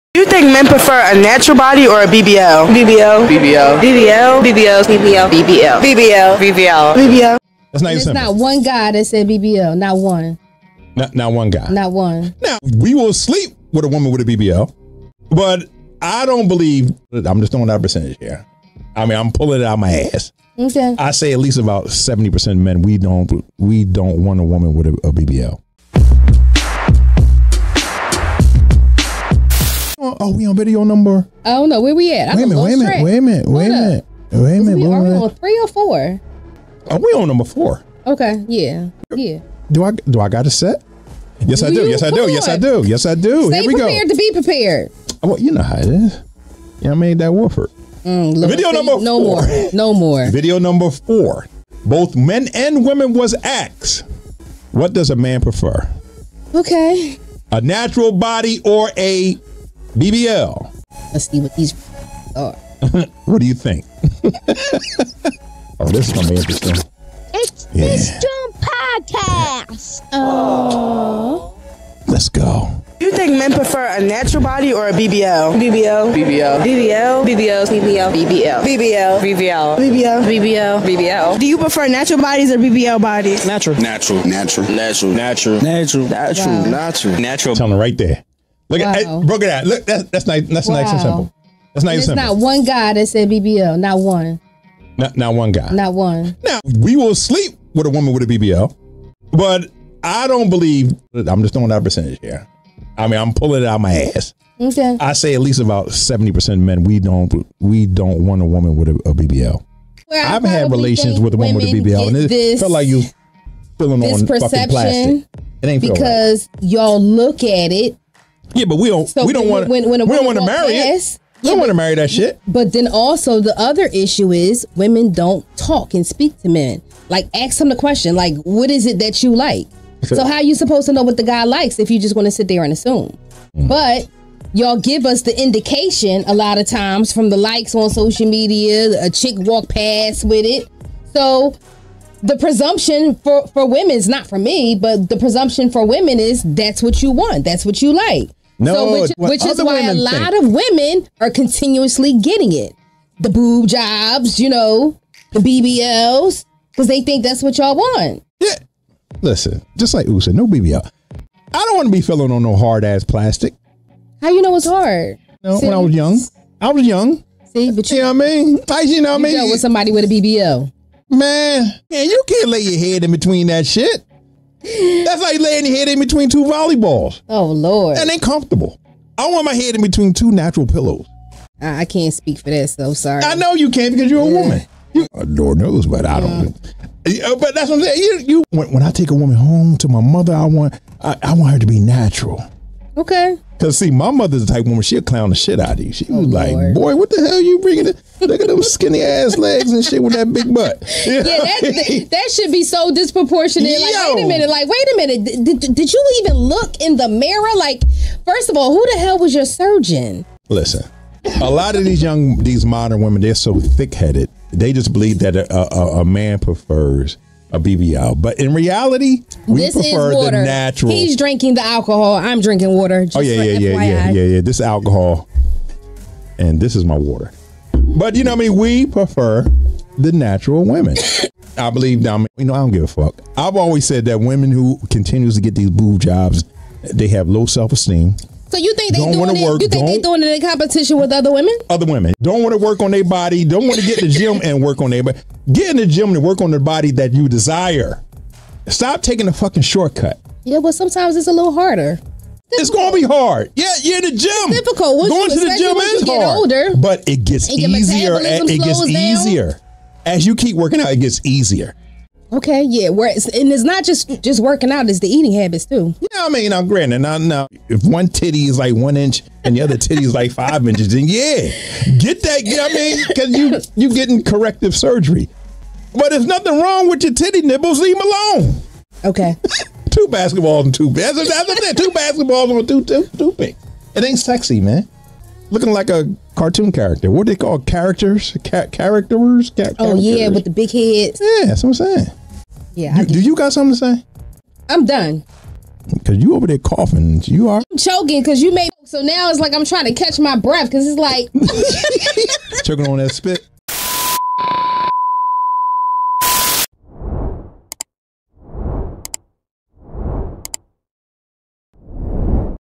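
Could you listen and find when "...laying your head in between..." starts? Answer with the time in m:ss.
2:55.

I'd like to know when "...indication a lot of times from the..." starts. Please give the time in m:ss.
2:15.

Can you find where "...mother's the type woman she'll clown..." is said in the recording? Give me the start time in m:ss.
3:14.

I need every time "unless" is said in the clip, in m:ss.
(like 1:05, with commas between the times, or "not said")
not said.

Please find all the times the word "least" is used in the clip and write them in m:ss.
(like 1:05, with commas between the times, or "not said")
0:21, 1:45.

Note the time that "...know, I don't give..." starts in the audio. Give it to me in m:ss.
3:52.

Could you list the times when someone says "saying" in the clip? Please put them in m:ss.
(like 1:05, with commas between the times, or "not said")
3:07, 4:51.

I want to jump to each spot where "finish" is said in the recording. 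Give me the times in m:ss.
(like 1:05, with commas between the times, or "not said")
not said.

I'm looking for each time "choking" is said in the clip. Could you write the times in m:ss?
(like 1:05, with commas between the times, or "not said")
4:57, 5:02.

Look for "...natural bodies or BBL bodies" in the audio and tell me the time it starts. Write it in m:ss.
1:21.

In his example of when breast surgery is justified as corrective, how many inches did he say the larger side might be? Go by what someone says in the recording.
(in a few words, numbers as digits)
5 inches.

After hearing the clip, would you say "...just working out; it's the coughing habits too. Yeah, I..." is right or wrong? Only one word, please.
wrong.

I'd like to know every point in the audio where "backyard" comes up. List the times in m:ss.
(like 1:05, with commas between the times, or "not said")
not said.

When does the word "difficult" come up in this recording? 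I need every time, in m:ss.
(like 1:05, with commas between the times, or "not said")
4:14.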